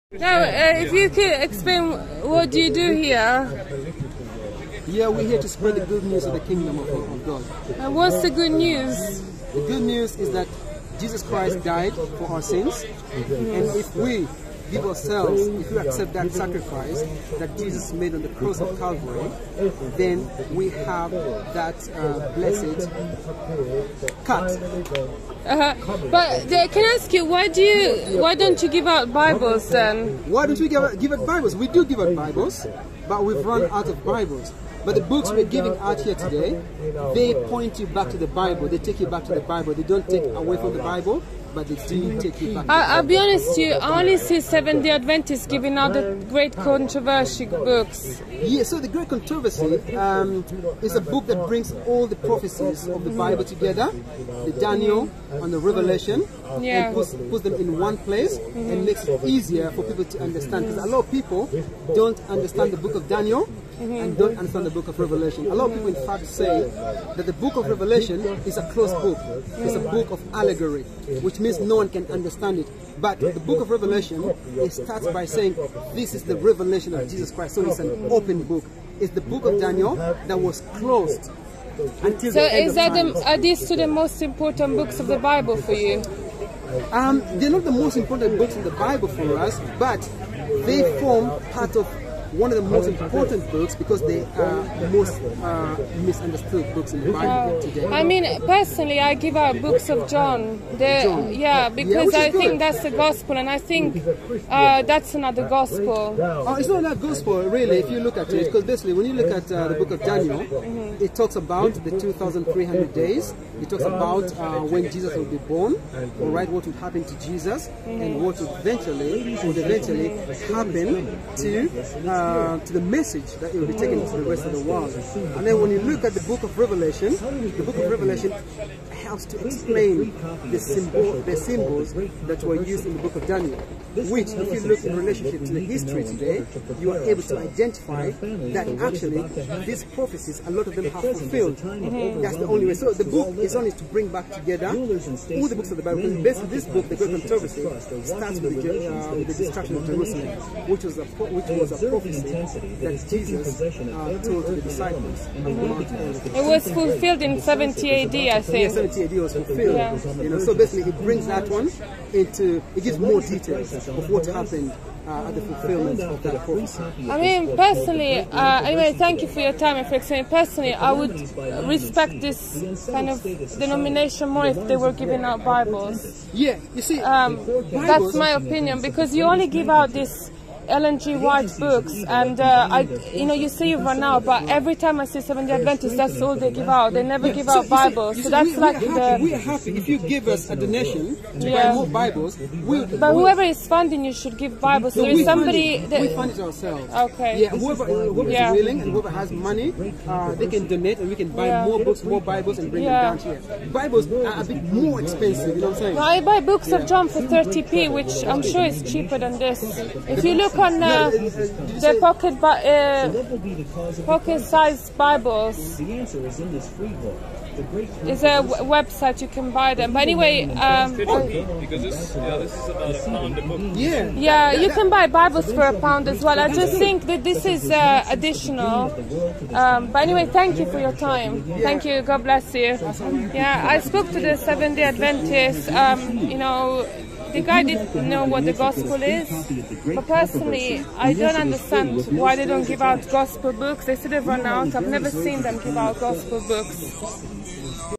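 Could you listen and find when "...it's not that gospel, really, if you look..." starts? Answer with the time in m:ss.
1:46.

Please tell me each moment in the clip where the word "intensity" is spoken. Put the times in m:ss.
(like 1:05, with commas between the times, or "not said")
2:32.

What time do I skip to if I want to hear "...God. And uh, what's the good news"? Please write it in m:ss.
0:07.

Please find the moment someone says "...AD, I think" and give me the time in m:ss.
2:37.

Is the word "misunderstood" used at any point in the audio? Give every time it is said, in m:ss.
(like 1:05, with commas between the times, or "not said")
1:35.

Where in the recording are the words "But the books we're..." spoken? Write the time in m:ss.
0:34.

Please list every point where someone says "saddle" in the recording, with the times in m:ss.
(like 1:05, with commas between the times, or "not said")
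not said.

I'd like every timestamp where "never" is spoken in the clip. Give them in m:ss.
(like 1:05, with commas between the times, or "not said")
3:07, 4:04.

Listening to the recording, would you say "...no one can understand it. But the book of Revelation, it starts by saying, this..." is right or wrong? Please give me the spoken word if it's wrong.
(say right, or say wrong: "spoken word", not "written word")
right.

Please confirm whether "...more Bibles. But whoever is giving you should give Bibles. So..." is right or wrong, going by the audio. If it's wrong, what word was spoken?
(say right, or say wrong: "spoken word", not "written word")
wrong: "funding", not "giving".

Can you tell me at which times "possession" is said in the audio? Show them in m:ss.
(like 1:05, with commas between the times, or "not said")
2:33.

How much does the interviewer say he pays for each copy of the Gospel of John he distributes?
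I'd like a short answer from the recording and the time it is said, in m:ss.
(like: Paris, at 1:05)
30p, at 3:27.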